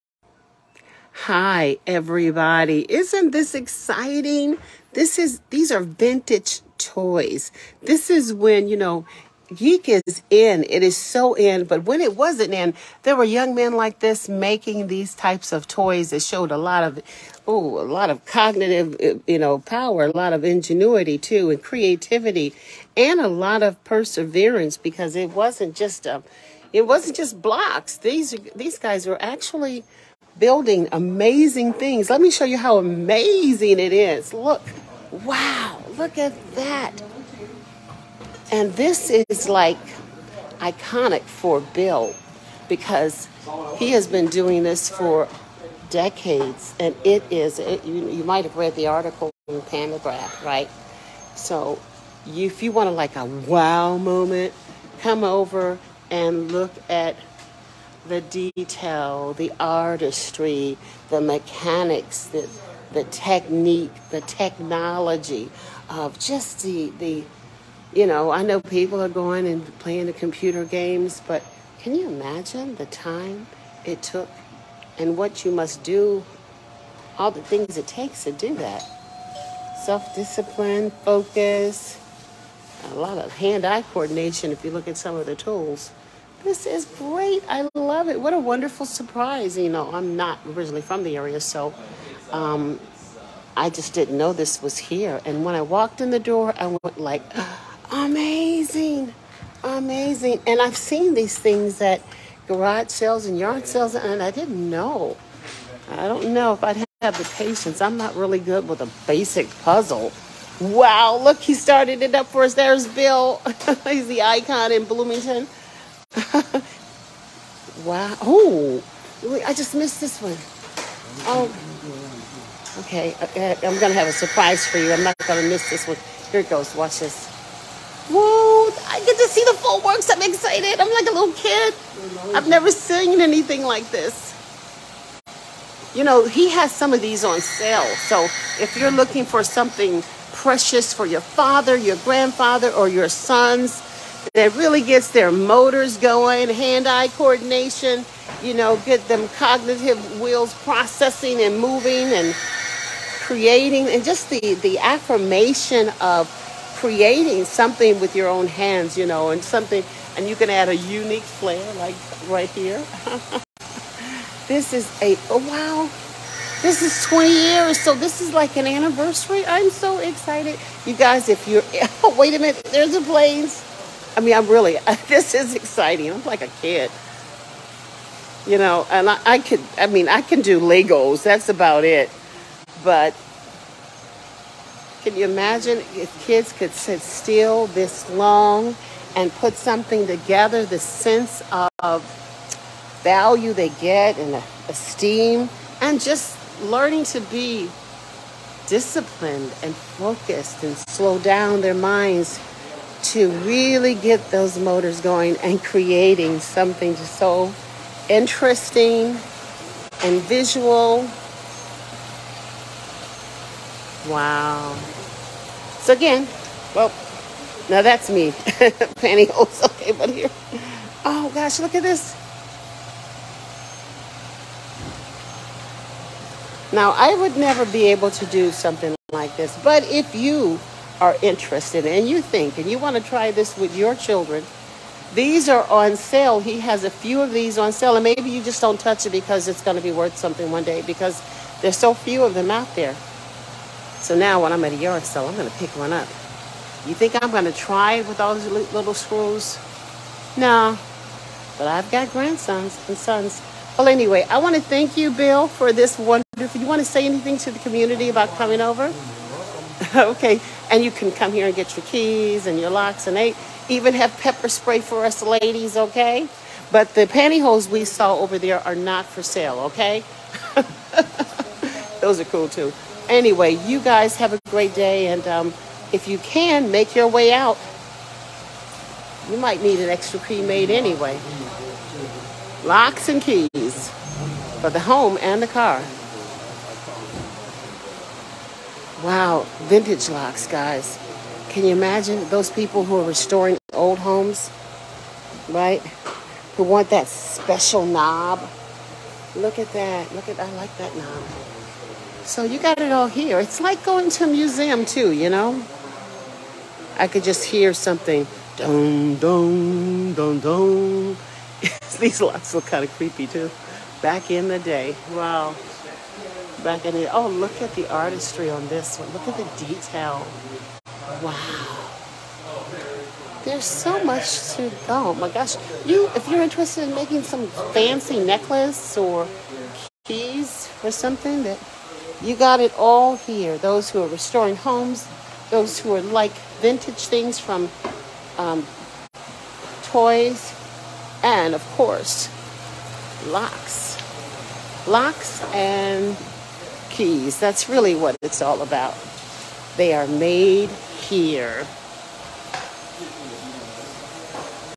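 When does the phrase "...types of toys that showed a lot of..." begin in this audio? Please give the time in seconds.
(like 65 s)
15 s.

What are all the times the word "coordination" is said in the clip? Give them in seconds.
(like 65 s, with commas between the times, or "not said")
83 s, 147 s.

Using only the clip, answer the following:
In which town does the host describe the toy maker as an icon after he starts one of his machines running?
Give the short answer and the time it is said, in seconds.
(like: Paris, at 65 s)
Bloomington, at 114 s.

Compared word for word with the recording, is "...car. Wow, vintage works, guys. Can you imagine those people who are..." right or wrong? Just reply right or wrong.
wrong.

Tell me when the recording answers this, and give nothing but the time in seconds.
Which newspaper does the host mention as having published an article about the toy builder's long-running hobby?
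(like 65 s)
49 s.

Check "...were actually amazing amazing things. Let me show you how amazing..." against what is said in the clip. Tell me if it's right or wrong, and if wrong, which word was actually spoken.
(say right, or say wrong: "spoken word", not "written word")
wrong: "building", not "amazing".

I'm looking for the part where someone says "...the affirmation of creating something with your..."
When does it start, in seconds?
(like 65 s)
154 s.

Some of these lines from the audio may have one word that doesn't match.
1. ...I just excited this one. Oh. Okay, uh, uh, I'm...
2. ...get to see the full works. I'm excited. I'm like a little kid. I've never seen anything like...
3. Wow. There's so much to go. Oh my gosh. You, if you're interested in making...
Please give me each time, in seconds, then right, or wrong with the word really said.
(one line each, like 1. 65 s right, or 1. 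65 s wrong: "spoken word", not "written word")
1. 119 s wrong: "missed", not "excited"
2. 129 s right
3. 321 s right.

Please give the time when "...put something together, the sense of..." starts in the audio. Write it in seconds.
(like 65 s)
189 s.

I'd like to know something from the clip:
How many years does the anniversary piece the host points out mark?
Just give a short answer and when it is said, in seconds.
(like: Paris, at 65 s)
20, at 167 s.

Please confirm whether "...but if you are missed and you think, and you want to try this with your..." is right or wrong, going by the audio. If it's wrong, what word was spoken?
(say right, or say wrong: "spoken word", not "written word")
wrong: "interested", not "missed".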